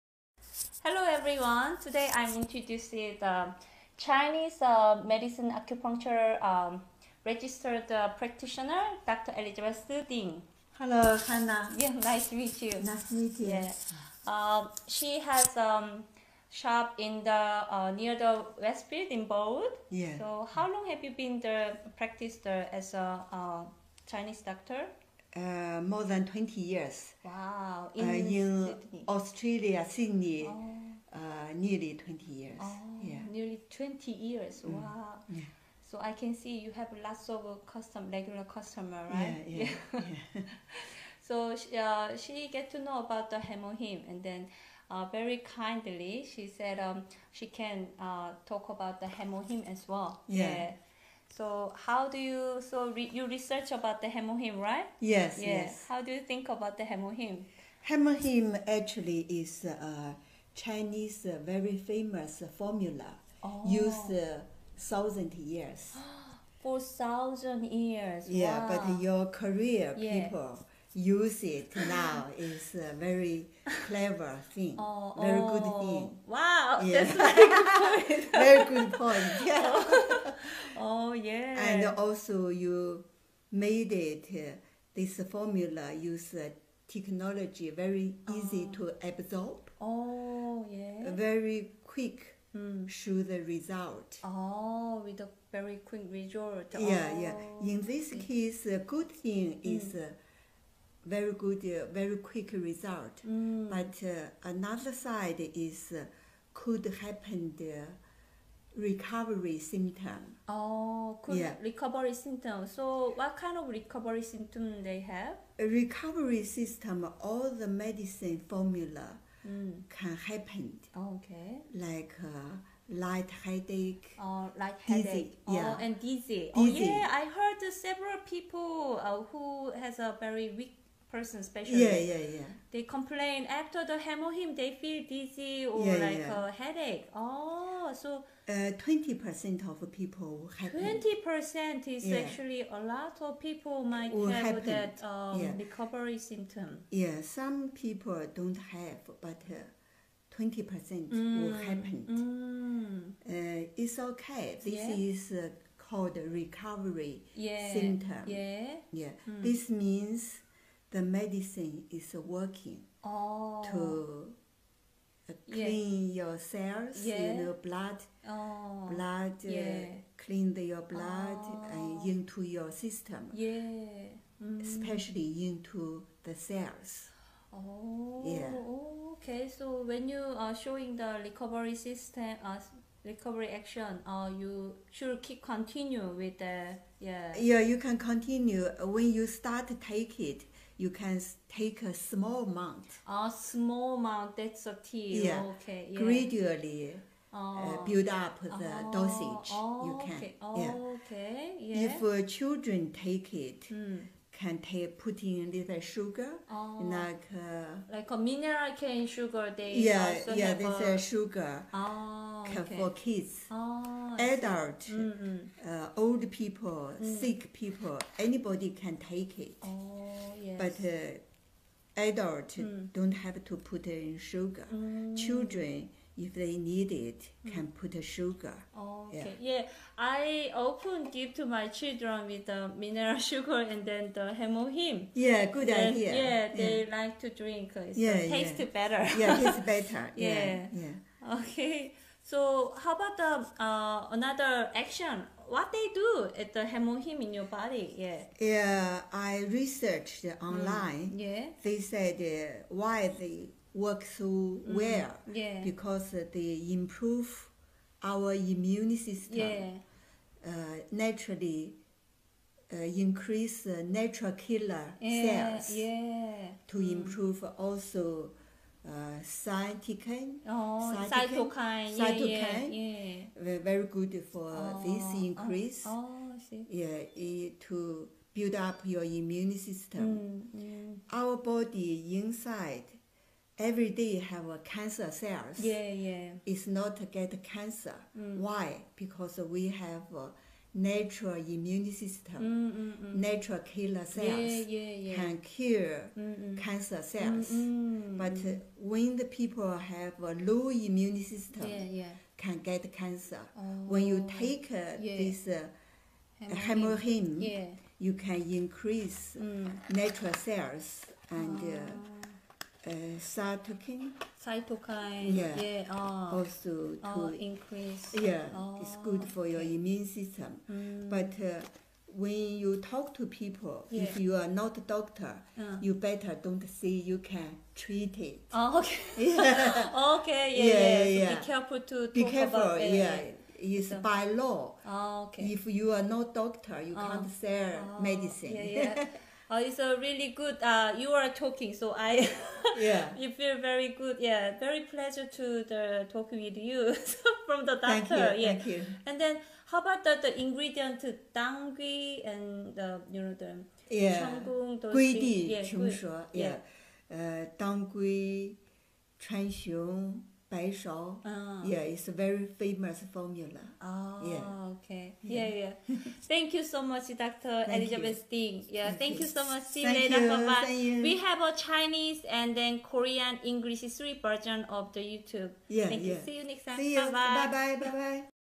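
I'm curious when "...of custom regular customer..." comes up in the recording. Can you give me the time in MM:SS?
00:37.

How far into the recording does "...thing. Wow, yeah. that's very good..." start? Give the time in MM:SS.
01:15.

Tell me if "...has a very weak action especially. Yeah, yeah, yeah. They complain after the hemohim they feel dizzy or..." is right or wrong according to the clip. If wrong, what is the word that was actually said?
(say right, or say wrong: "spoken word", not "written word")
wrong: "person", not "action".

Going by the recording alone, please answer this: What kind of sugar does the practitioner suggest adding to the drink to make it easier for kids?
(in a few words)
cane sugar.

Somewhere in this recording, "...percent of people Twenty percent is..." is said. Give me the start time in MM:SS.
02:19.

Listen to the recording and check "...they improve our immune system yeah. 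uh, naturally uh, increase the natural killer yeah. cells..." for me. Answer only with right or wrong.
right.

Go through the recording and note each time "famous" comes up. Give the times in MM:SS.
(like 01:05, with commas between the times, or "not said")
01:01, 06:02.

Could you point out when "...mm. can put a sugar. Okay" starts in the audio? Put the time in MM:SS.
03:47.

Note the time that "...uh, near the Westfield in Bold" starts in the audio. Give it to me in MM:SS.
00:17.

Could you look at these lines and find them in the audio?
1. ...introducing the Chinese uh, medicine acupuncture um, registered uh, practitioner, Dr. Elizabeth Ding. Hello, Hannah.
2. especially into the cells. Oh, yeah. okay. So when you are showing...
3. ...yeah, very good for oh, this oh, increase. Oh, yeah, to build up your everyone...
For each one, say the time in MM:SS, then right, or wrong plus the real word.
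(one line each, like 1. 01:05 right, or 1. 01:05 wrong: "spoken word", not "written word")
1. 00:02 right
2. 02:54 right
3. 04:33 wrong: "immune", not "everyone".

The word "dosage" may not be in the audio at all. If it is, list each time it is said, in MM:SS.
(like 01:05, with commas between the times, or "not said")
03:18.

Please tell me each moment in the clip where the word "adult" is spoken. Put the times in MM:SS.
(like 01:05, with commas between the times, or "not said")
03:34, 03:42.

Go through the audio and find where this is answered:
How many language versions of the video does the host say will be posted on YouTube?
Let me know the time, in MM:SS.
06:13.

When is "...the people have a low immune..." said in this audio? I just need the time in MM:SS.
04:59.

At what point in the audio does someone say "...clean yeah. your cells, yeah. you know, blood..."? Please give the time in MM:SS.
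02:45.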